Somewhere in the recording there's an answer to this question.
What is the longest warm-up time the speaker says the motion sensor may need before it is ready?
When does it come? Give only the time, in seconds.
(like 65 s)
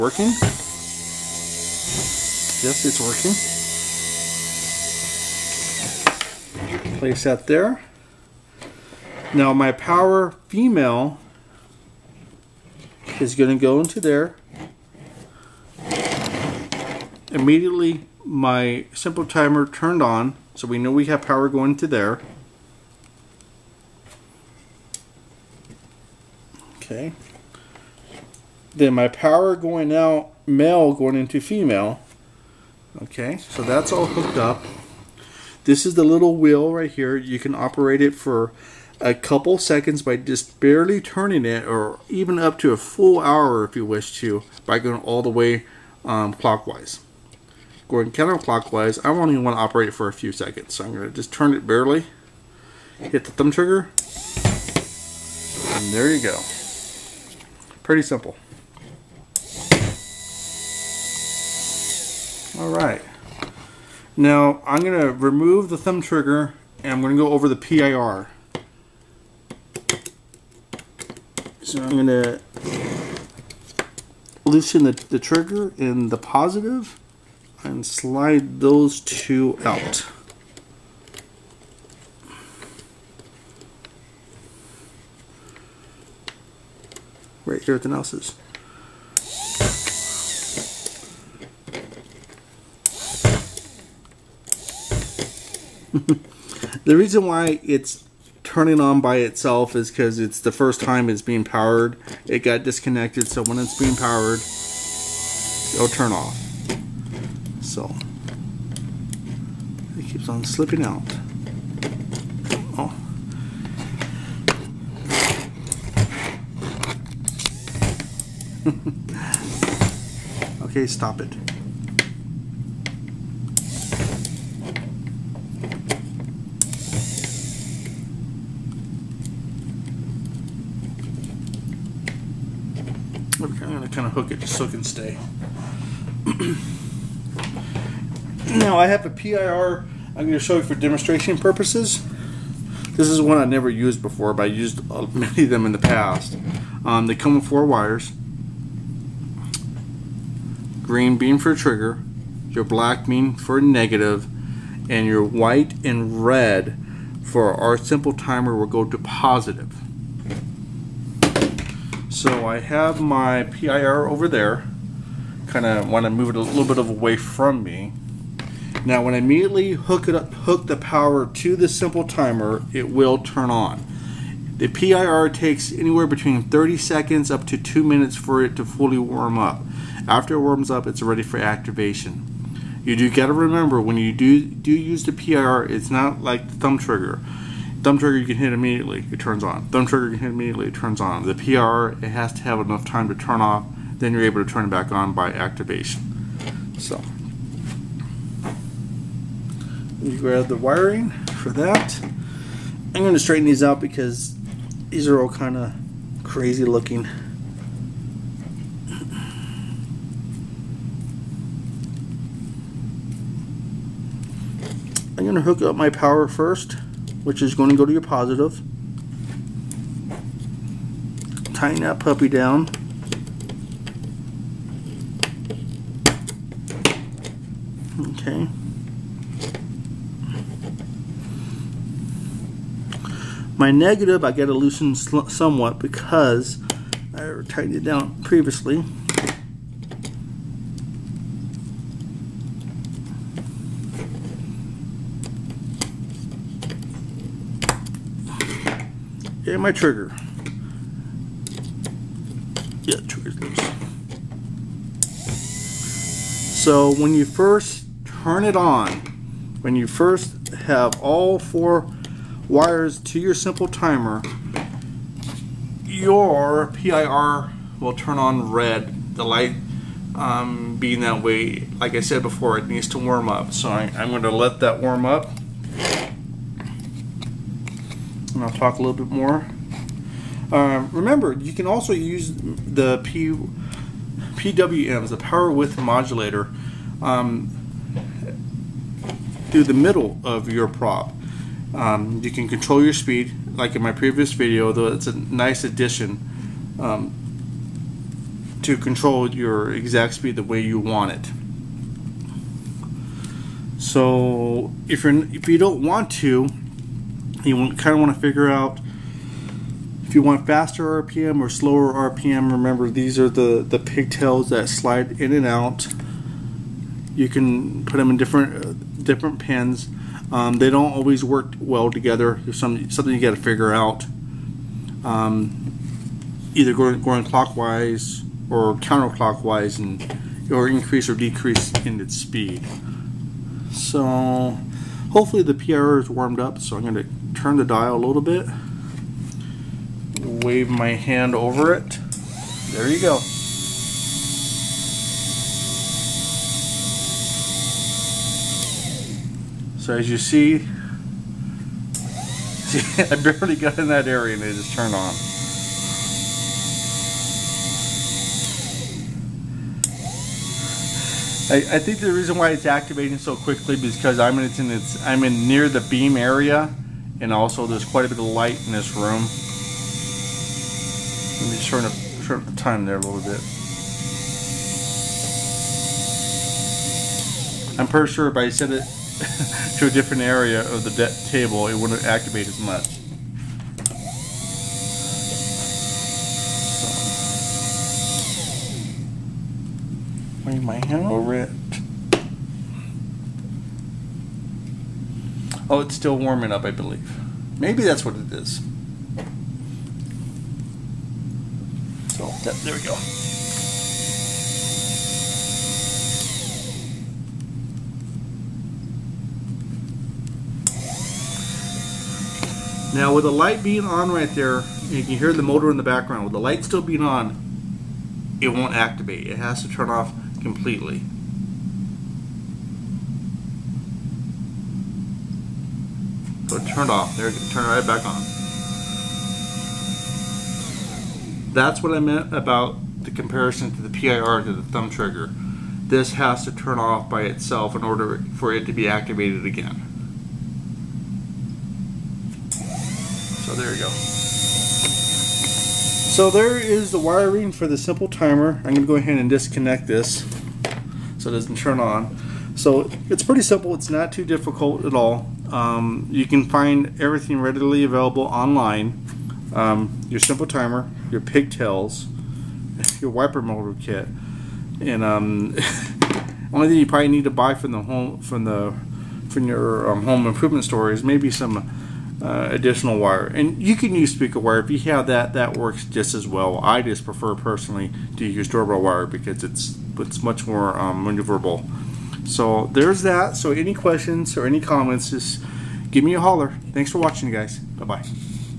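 177 s.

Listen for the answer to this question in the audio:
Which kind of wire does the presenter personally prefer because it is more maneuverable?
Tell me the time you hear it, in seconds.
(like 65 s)
478 s.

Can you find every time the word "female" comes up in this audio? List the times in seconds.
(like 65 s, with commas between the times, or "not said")
10 s, 31 s.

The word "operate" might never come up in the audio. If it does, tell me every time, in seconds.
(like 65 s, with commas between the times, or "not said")
37 s, 49 s.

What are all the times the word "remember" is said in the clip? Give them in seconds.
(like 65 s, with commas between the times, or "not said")
183 s, 280 s, 312 s.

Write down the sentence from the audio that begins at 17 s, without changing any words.
Immediately my simple timer turned on so we know we have power going to there.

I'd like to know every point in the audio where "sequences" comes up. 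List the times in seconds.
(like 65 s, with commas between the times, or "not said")
not said.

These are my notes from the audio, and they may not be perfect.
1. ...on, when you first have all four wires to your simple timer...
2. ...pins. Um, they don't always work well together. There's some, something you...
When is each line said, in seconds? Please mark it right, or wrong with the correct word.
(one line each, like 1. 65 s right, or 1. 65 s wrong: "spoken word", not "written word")
1. 258 s right
2. 319 s right.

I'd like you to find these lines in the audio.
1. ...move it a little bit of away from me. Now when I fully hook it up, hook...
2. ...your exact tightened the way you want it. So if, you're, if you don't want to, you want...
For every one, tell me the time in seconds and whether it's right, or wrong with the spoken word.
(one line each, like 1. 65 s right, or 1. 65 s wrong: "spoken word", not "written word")
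1. 166 s wrong: "immediately", not "fully"
2. 299 s wrong: "speed", not "tightened".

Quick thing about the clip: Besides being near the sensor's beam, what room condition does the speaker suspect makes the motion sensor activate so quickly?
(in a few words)
quite a bit of light.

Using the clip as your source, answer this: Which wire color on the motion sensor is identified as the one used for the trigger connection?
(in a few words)
Green.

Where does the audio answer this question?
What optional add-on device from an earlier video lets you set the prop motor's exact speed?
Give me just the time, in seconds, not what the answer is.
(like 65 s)
285 s.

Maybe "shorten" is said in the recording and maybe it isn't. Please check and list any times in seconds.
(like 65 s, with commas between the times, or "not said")
371 s.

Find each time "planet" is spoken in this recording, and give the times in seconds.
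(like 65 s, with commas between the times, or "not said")
not said.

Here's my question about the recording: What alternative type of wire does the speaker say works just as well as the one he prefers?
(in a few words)
speaker wire.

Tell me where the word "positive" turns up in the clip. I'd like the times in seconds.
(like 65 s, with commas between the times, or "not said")
76 s, 158 s, 218 s.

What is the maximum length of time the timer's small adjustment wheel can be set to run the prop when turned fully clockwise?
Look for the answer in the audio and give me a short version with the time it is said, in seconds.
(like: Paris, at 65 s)
a full hour, at 42 s.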